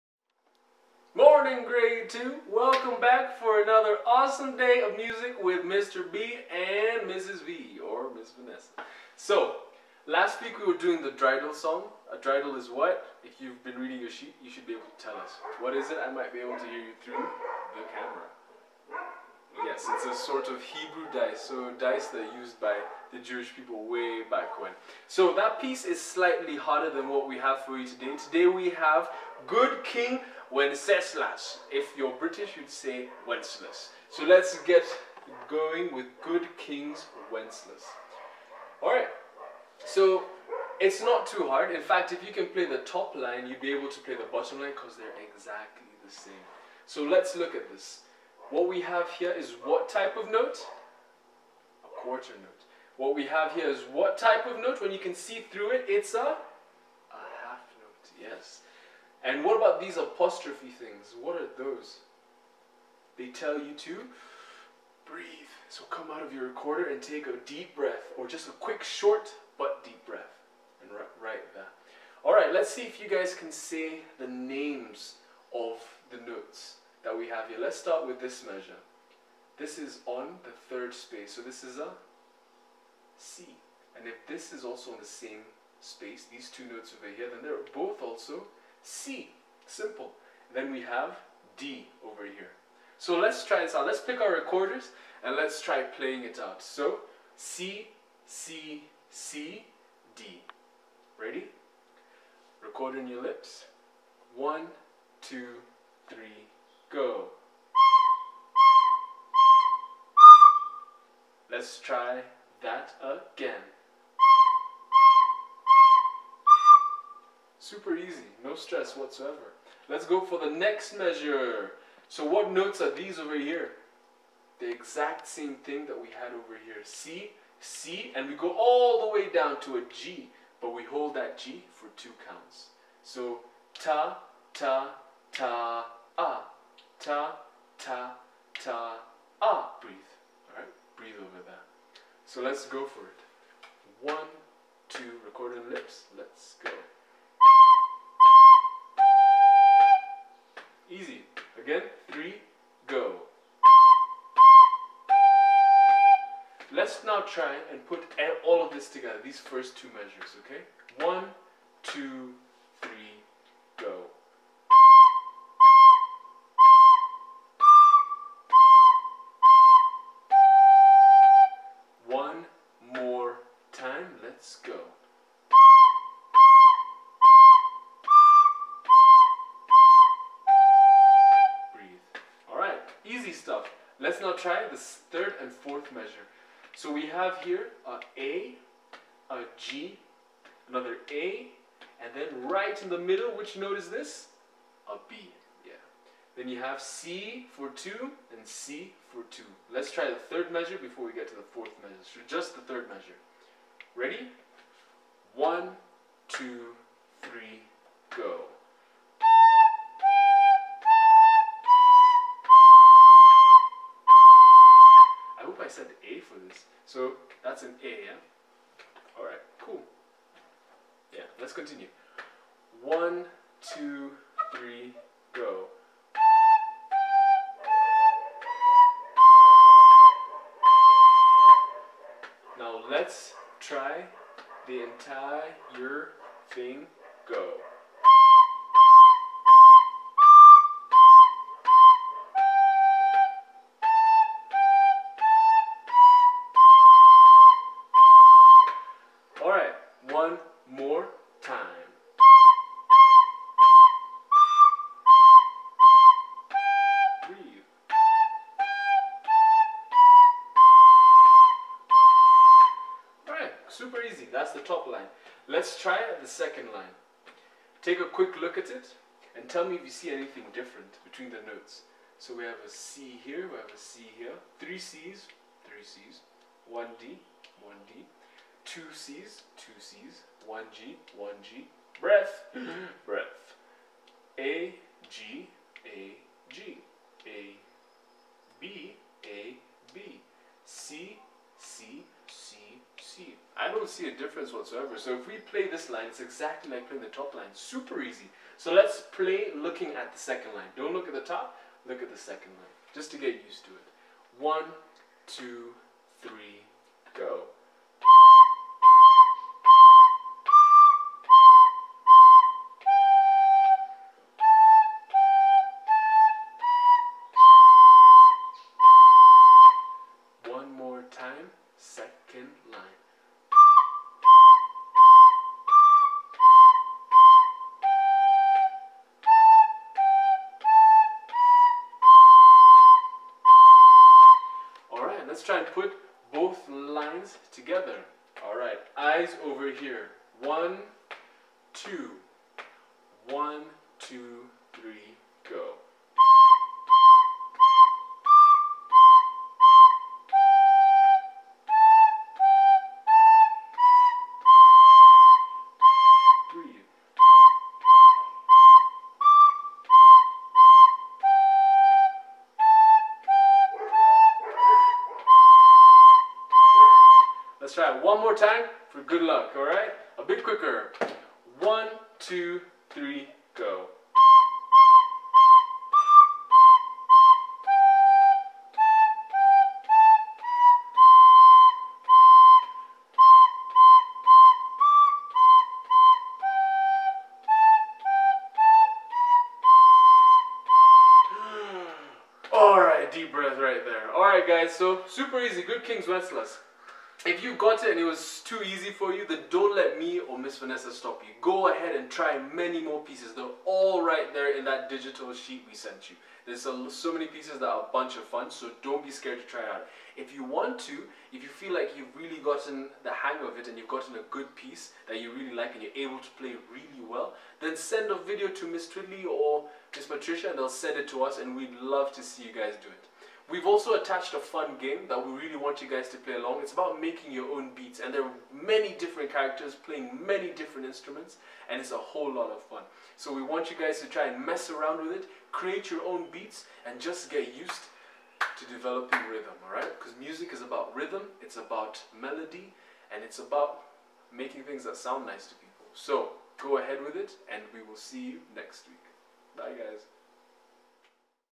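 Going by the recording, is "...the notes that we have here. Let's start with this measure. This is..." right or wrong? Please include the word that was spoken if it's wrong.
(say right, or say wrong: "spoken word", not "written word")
right.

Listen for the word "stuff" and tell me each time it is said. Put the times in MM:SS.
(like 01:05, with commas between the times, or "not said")
03:03.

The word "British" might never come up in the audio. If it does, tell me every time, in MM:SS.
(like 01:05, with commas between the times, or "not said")
00:32.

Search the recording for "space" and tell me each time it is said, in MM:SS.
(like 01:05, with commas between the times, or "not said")
01:20, 01:25.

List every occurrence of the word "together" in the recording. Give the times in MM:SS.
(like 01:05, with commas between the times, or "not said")
02:38, 05:37.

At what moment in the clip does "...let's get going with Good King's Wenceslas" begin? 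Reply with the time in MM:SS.
00:34.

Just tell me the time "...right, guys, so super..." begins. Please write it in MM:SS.
06:34.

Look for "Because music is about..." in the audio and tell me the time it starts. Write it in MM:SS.
07:19.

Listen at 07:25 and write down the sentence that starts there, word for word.
So go ahead with it and we will see you next week.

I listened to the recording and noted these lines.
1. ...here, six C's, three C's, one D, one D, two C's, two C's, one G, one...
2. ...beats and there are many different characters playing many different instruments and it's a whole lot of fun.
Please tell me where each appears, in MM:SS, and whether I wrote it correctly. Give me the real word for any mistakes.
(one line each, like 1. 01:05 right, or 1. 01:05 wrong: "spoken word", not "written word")
1. 04:34 wrong: "three", not "six"
2. 07:07 right.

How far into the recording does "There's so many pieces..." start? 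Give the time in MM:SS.
06:46.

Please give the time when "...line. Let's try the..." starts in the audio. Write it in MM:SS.
04:24.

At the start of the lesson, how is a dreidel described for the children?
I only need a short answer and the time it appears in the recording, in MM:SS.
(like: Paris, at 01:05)
Hebrew dice, at 00:20.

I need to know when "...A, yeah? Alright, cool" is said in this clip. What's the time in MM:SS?
03:37.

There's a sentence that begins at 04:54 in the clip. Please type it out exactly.
So if we play this line, it's exactly like playing the top line.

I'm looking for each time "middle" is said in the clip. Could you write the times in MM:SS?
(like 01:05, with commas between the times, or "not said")
03:12.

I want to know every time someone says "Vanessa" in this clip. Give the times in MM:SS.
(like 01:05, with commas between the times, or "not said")
00:08, 06:40.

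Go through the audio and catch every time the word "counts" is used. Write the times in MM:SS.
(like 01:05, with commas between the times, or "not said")
02:12.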